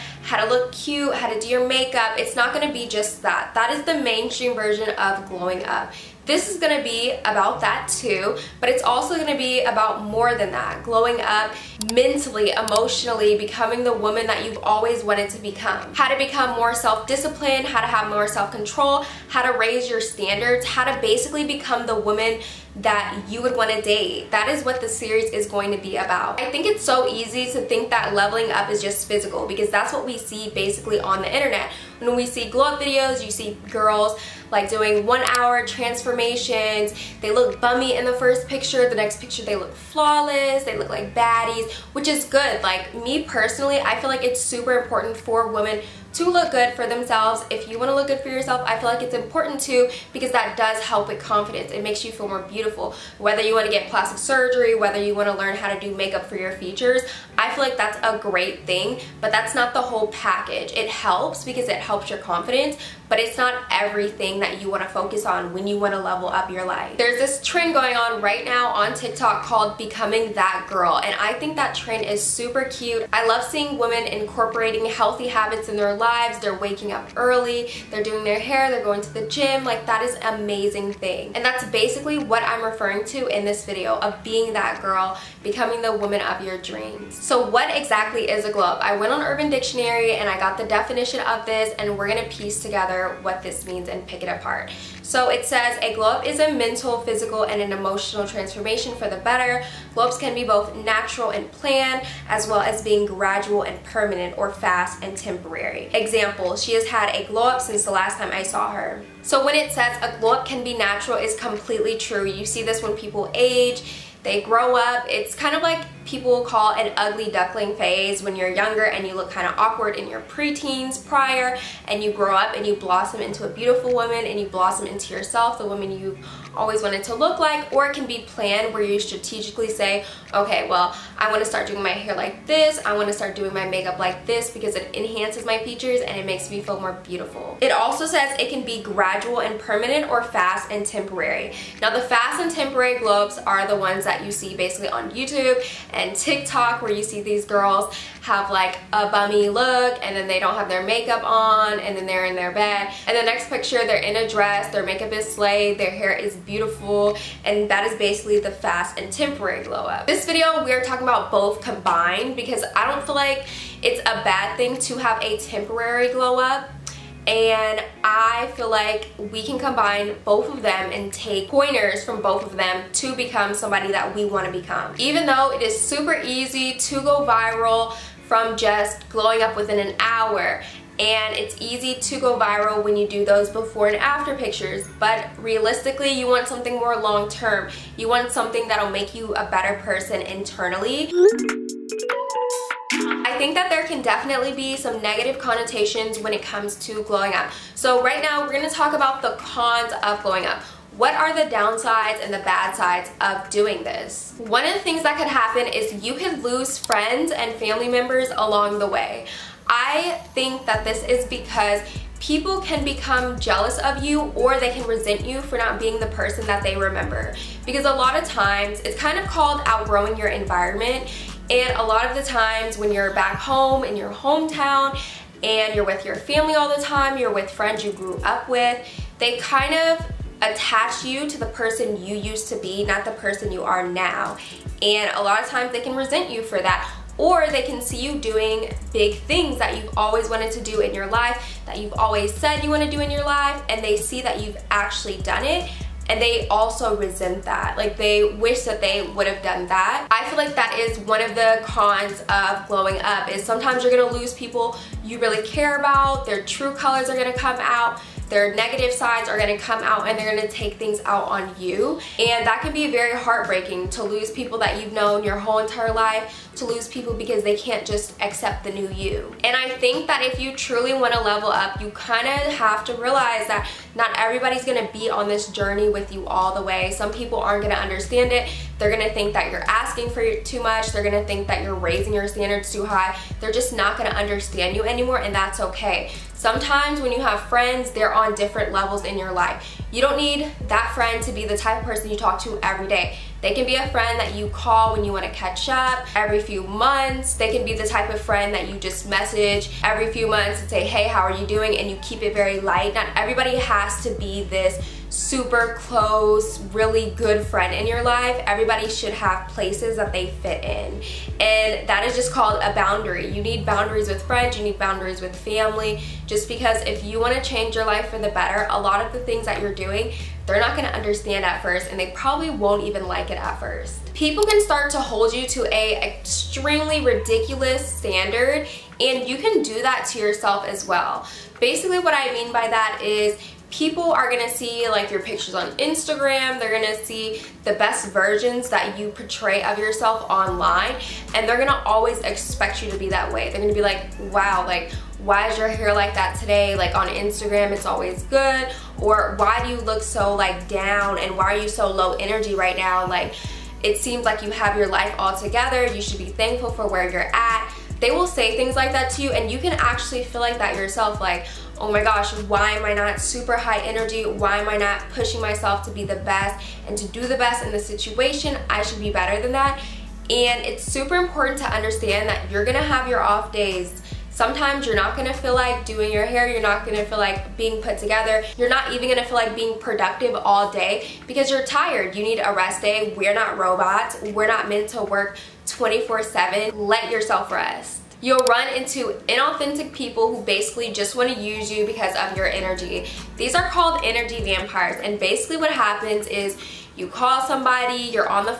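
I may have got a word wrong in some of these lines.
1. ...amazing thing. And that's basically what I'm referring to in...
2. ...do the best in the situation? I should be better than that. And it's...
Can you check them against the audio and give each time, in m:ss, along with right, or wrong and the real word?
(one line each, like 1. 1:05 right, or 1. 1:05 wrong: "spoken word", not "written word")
1. 1:20 right
2. 6:07 right.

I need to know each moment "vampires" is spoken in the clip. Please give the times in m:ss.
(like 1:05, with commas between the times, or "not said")
6:34.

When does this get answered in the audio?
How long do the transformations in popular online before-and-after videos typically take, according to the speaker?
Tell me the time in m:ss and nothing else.
0:35.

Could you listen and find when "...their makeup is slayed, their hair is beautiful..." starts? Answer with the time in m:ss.
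2:34.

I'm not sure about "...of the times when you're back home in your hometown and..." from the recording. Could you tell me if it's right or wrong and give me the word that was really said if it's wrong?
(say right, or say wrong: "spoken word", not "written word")
right.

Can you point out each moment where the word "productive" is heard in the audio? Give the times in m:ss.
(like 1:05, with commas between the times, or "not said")
6:19.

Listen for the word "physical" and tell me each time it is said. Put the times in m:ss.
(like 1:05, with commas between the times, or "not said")
0:29, 1:37.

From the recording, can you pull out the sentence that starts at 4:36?
Some people aren't gonna understand it.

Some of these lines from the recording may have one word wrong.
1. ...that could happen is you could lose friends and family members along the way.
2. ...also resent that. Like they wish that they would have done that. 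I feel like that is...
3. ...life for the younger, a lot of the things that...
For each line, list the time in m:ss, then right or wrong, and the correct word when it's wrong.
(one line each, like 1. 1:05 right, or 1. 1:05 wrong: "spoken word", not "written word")
1. 3:25 right
2. 4:06 right
3. 5:17 wrong: "better", not "younger".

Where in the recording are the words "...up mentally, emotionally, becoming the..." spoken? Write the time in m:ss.
0:11.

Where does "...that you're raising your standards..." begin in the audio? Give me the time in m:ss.
4:41.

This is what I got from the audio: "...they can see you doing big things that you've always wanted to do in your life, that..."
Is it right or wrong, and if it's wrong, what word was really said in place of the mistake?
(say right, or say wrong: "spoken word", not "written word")
right.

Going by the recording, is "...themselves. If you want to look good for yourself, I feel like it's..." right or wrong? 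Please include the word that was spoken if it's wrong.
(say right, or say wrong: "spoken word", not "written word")
right.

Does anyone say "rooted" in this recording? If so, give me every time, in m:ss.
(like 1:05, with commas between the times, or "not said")
not said.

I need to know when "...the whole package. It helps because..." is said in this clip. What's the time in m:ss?
0:59.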